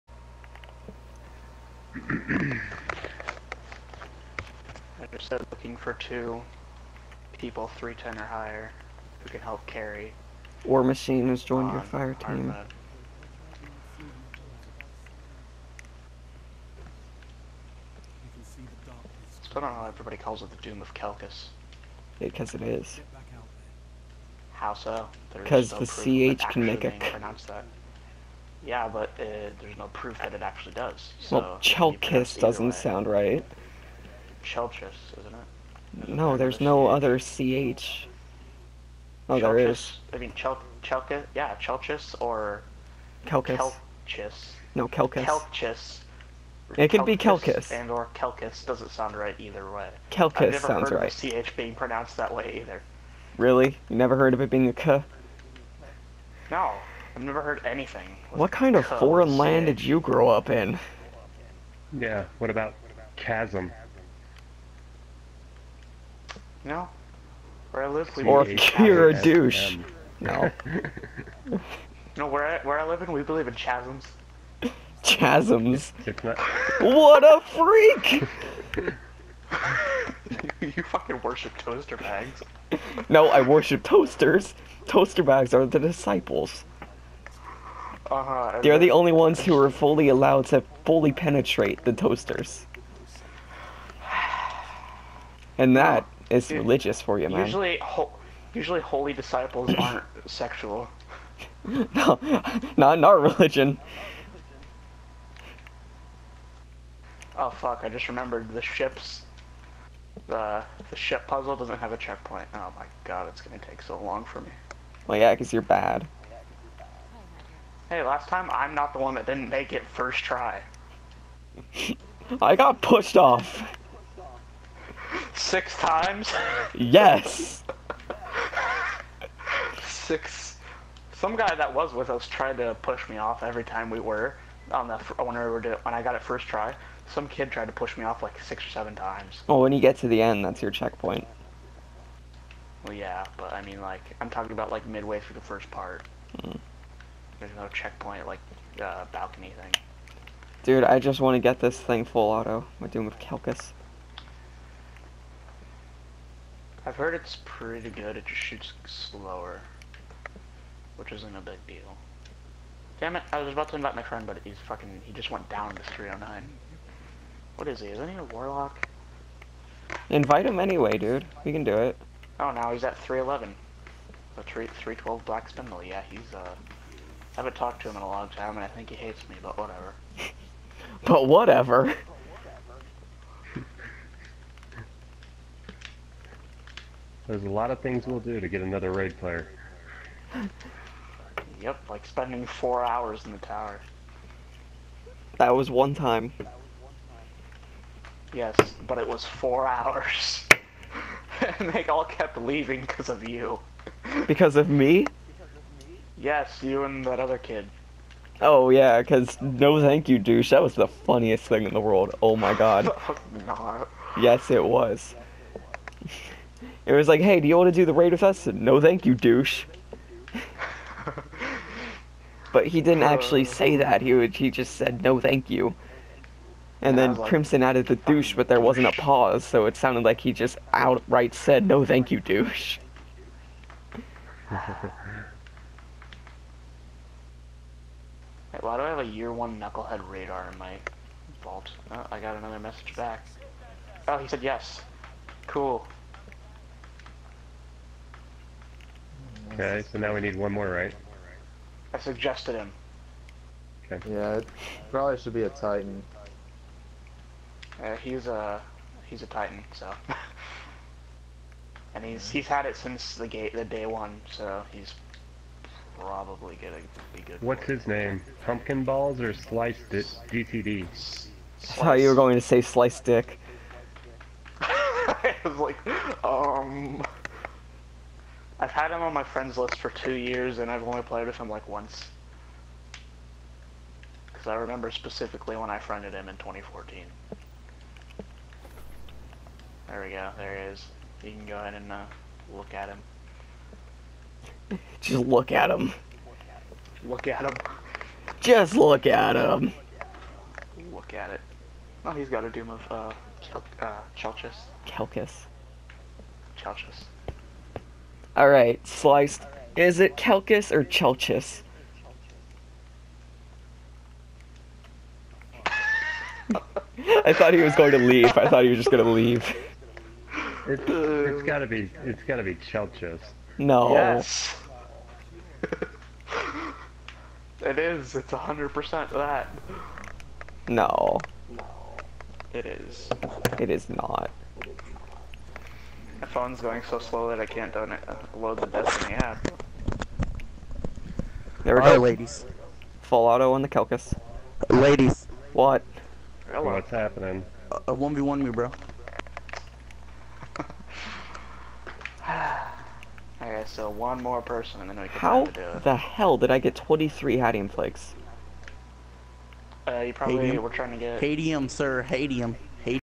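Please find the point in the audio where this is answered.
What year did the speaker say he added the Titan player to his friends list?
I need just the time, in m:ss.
4:46.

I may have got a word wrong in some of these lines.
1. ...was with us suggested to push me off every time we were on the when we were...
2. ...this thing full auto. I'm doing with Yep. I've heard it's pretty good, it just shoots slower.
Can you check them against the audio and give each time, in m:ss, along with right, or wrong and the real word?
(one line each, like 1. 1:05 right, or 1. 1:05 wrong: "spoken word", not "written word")
1. 2:11 wrong: "tried", not "suggested"
2. 2:31 wrong: "Kelkus", not "Yep".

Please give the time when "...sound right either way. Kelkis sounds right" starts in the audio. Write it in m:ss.
0:48.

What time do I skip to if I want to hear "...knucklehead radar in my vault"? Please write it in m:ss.
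3:59.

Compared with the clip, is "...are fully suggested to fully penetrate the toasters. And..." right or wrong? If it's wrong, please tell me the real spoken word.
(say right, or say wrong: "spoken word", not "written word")
wrong: "allowed", not "suggested".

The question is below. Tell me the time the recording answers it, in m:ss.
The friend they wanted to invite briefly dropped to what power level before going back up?
2:45.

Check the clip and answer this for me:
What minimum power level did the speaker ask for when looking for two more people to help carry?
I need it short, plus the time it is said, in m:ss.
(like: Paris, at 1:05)
310, at 0:07.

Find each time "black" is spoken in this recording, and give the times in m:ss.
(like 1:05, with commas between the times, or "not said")
2:55.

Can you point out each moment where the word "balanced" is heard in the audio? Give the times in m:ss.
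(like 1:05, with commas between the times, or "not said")
not said.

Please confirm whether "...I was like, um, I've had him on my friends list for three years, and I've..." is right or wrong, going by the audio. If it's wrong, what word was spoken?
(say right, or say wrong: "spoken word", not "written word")
wrong: "two", not "three".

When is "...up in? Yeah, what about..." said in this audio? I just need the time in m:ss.
1:00.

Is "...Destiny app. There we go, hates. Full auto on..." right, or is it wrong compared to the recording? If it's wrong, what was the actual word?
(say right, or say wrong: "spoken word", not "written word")
wrong: "ladies", not "hates".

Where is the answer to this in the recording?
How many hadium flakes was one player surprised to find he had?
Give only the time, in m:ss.
5:56.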